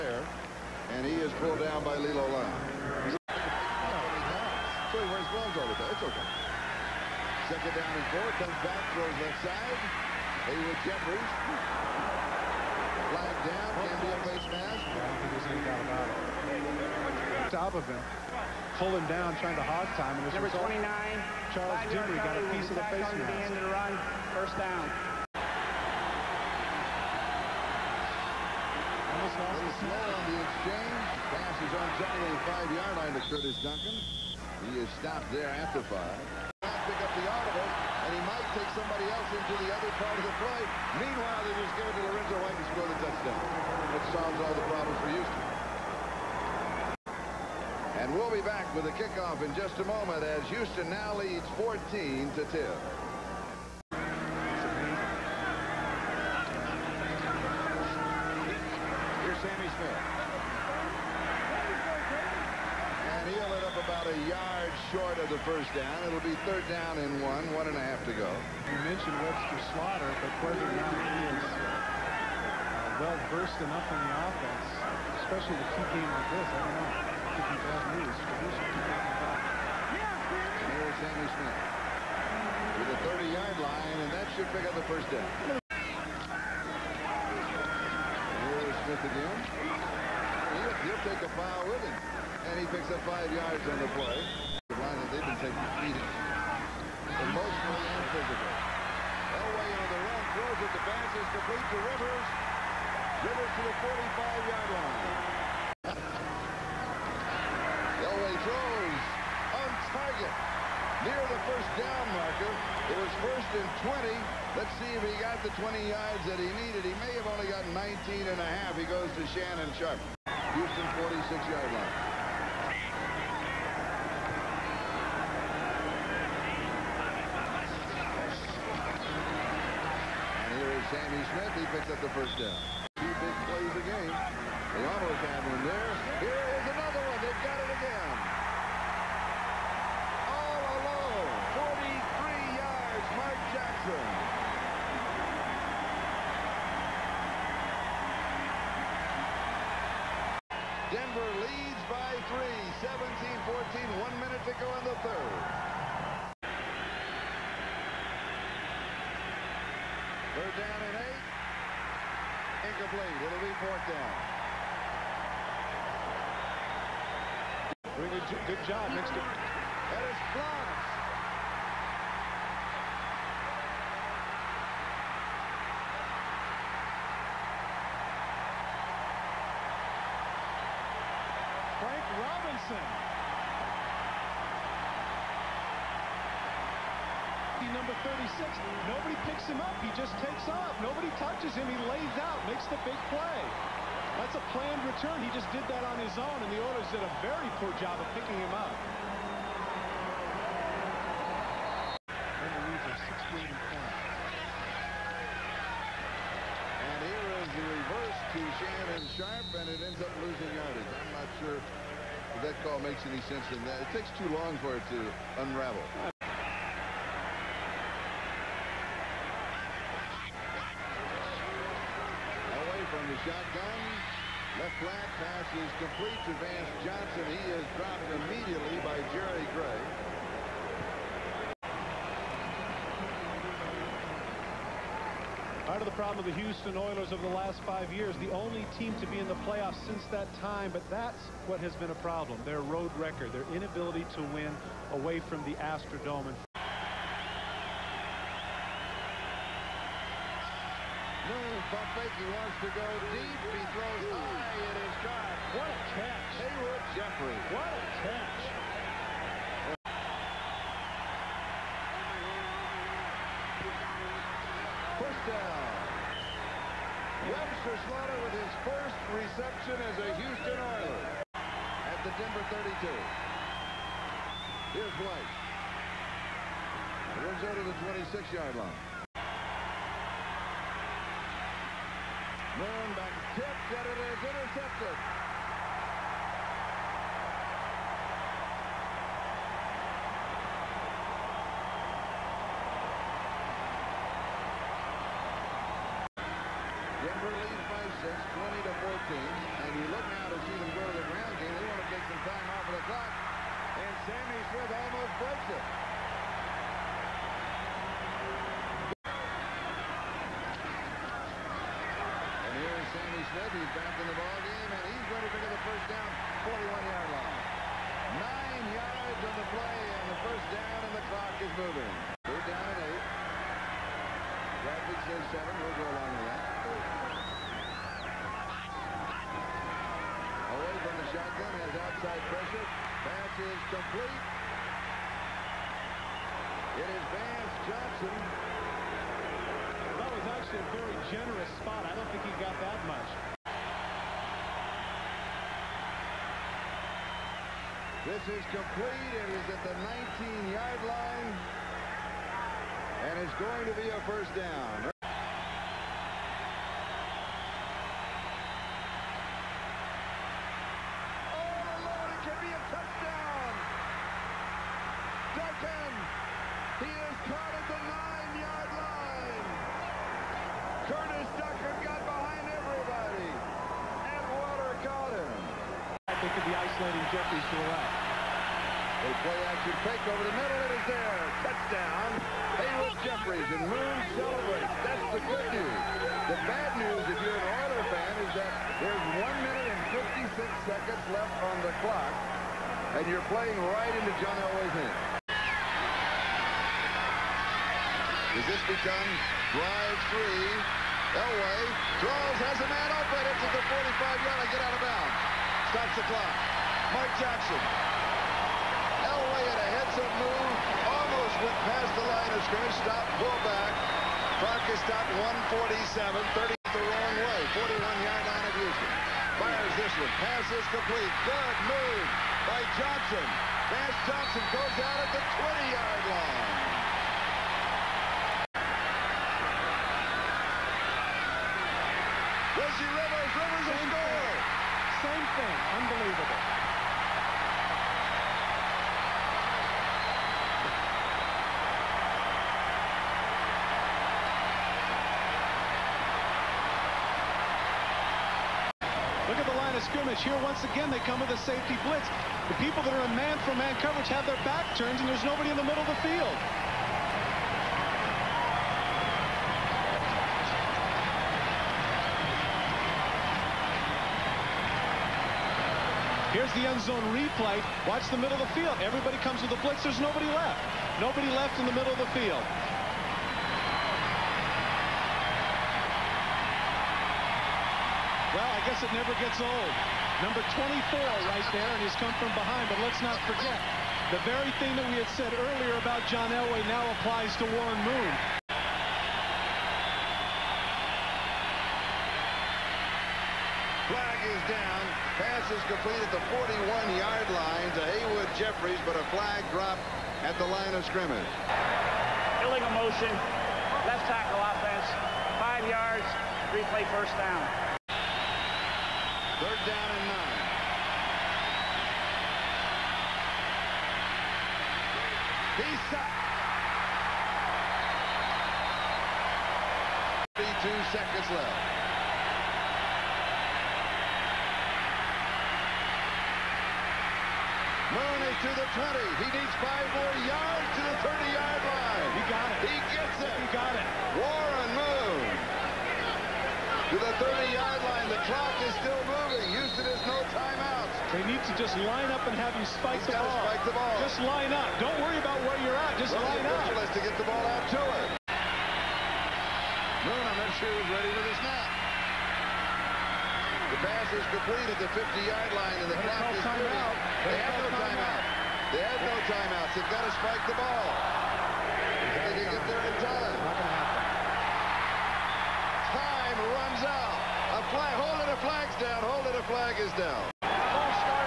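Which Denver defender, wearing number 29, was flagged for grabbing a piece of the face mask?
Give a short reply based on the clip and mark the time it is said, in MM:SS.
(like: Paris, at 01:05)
Charles Dimry, at 00:21.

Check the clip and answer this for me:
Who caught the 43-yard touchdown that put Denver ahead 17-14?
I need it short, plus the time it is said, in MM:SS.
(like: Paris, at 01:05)
Mark Jackson, at 02:23.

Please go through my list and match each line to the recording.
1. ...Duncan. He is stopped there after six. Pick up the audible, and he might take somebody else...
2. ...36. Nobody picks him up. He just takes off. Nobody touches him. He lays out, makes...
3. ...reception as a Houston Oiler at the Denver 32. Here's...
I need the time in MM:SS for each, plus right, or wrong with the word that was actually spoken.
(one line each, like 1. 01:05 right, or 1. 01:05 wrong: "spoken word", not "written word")
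1. 00:33 wrong: "five", not "six"
2. 03:08 right
3. 04:29 right.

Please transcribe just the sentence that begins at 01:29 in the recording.
He'll, he'll take a foul with him and he picks up five yards on the play.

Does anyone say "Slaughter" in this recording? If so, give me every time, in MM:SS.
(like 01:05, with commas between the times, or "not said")
01:09, 04:27.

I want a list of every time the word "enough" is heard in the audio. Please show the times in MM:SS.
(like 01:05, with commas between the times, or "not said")
01:13.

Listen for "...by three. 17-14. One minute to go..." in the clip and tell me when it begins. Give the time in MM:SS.
02:31.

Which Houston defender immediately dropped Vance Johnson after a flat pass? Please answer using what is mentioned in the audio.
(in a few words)
Jerry Gray.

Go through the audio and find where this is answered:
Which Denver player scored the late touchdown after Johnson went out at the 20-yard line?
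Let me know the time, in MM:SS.
07:12.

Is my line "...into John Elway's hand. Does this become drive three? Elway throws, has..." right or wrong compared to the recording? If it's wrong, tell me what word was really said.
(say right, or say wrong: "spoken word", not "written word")
right.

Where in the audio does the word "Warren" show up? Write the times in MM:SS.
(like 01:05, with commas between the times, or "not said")
08:07, 08:54.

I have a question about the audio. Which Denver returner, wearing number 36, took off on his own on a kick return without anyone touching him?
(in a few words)
Frank Robinson.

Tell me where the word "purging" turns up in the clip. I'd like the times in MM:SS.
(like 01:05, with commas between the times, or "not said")
not said.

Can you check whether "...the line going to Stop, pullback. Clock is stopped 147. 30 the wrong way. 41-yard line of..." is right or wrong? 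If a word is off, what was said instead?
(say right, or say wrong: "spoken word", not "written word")
right.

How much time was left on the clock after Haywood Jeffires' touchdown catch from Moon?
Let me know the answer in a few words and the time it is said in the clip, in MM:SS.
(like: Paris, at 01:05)
1 minute 56 seconds, at 06:29.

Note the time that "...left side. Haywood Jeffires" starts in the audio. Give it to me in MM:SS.
00:09.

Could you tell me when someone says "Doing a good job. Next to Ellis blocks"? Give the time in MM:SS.
02:47.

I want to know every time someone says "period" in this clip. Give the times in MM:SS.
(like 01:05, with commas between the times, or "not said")
not said.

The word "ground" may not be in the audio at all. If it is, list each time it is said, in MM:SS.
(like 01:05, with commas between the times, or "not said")
05:01.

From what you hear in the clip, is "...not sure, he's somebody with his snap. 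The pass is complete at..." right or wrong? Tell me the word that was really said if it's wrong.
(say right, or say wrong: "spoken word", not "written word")
wrong: "ready", not "somebody".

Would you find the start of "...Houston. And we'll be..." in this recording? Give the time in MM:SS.
00:45.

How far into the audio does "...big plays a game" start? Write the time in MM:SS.
02:13.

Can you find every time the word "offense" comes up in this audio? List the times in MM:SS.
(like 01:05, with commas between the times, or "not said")
01:14, 08:24.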